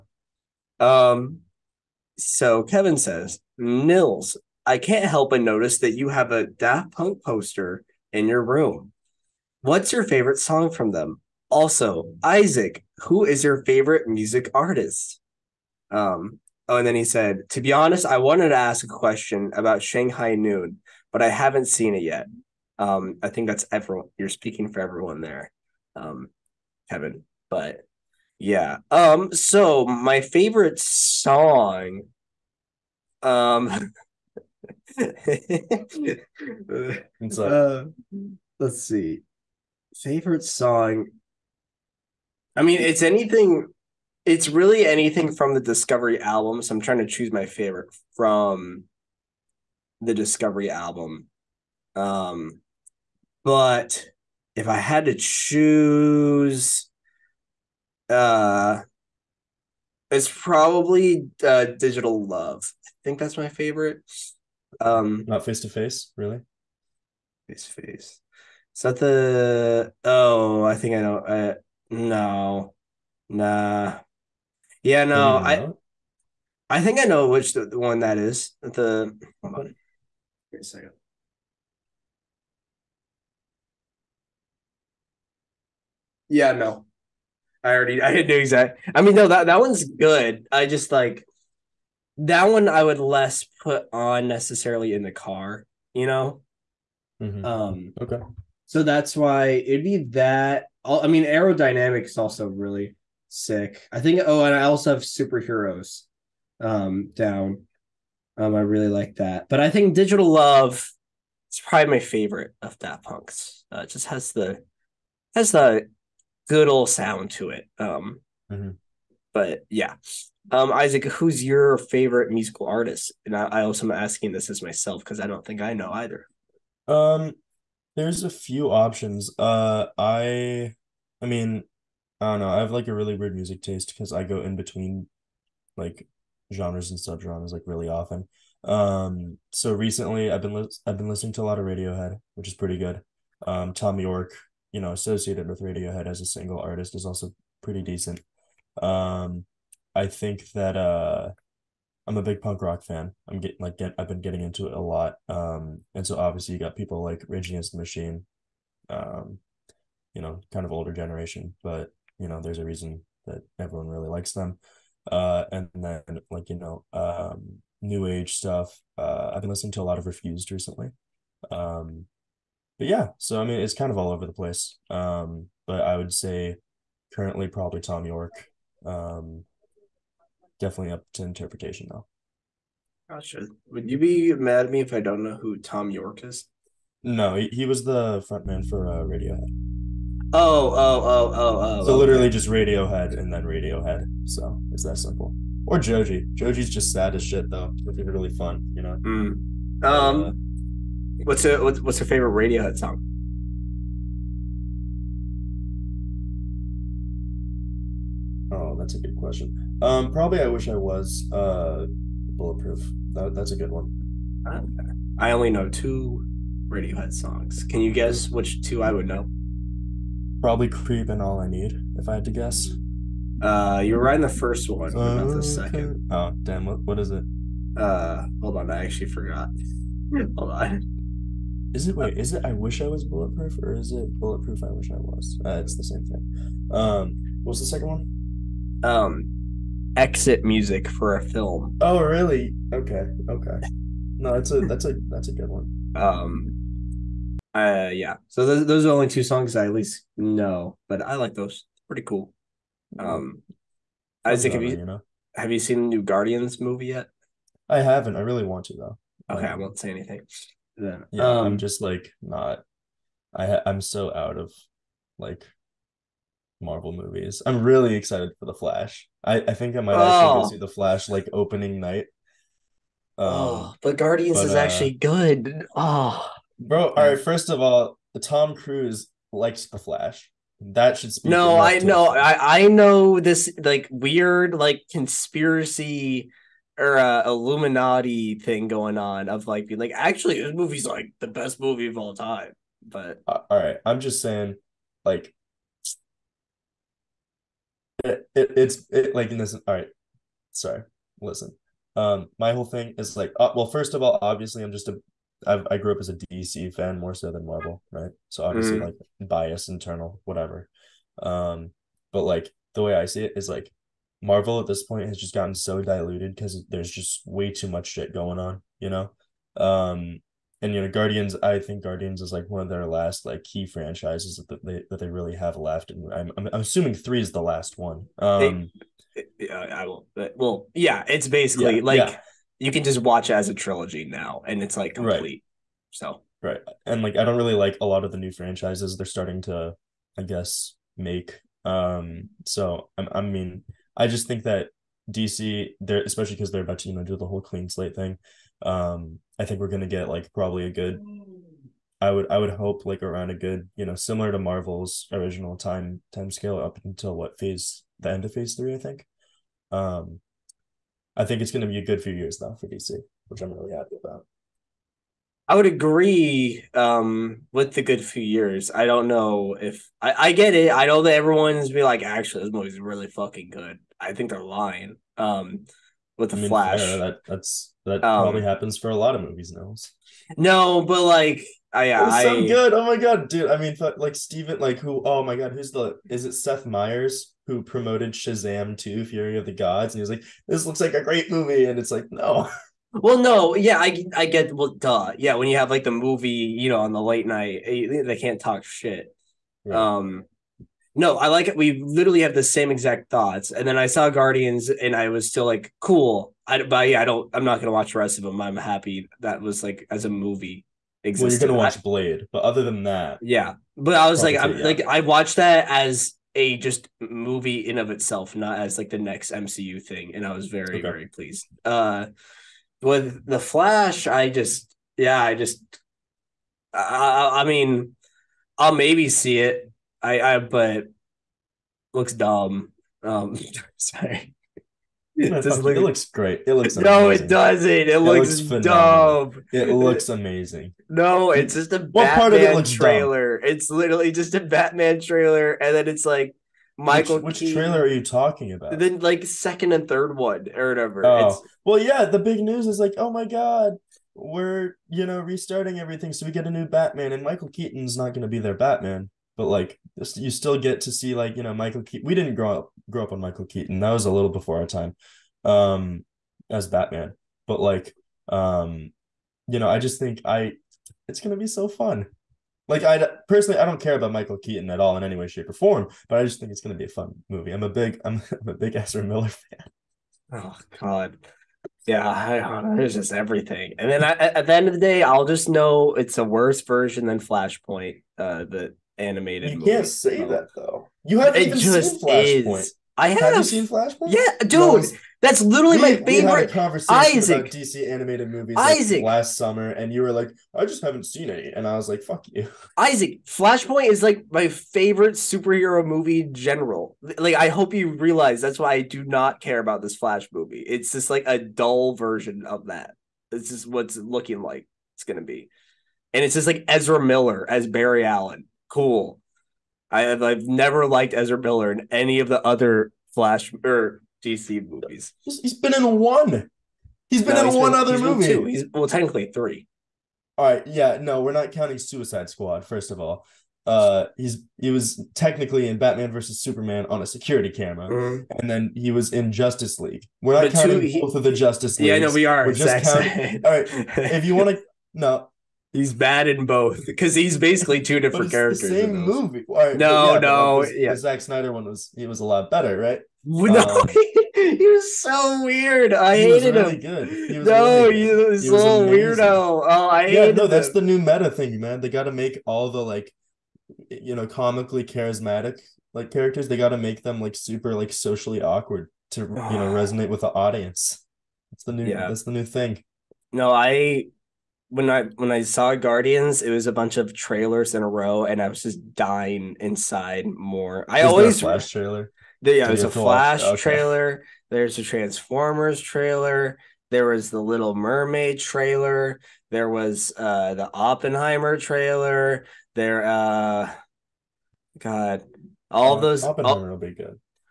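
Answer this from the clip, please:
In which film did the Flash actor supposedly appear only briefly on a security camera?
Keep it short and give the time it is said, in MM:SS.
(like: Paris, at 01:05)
Batman versus Superman, at 08:55.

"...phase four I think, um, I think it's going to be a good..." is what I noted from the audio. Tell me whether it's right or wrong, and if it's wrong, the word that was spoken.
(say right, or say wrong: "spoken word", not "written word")
wrong: "three", not "four".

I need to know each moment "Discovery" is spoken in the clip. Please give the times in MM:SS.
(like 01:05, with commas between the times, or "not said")
00:45, 00:50.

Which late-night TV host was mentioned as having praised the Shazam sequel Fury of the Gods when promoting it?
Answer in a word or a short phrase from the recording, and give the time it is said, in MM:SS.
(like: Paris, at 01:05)
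Seth Meyers, at 06:26.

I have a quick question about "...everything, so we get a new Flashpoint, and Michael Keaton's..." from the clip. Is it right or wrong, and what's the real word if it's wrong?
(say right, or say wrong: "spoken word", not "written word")
wrong: "Batman", not "Flashpoint".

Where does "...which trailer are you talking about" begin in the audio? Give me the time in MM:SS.
07:27.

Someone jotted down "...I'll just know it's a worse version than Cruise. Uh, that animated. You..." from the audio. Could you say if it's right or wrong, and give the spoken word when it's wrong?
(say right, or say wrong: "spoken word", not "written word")
wrong: "Flashpoint", not "Cruise".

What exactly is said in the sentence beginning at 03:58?
Um, exit music for a film.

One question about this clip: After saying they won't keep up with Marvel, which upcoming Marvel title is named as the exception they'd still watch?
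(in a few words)
Blade.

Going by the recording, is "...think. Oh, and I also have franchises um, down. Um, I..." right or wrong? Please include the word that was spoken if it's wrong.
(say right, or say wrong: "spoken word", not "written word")
wrong: "superheroes", not "franchises".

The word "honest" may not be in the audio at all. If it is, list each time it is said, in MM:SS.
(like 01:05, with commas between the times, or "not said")
00:17.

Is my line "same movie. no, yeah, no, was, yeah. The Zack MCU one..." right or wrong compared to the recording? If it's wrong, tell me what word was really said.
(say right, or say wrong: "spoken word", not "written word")
wrong: "Snyder", not "MCU".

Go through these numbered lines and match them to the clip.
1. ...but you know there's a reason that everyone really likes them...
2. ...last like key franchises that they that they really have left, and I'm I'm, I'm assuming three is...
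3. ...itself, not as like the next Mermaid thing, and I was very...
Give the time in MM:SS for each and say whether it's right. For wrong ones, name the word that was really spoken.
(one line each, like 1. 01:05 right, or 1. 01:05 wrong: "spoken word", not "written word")
1. 02:41 right
2. 05:22 right
3. 06:57 wrong: "MCU", not "Mermaid".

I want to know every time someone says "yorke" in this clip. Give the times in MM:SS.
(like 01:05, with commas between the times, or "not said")
02:23, 02:58, 03:05.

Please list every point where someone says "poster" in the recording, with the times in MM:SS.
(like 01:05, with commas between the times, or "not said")
00:07.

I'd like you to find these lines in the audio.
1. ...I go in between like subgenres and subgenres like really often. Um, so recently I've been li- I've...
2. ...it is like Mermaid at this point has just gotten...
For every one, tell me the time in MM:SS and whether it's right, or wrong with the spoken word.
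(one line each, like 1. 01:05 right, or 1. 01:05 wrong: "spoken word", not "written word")
1. 02:14 wrong: "genres", not "subgenres"
2. 05:13 wrong: "Marvel", not "Mermaid".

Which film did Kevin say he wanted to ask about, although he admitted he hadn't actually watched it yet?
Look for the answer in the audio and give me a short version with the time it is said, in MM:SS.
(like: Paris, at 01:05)
Shanghai Noon, at 00:19.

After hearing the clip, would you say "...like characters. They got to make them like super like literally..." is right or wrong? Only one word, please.
wrong.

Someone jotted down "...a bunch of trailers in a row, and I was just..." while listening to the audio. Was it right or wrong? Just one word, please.
right.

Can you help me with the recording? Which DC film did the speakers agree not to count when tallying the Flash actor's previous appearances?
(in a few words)
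Suicide Squad.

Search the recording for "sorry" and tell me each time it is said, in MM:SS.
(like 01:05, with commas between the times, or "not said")
05:00, 07:13.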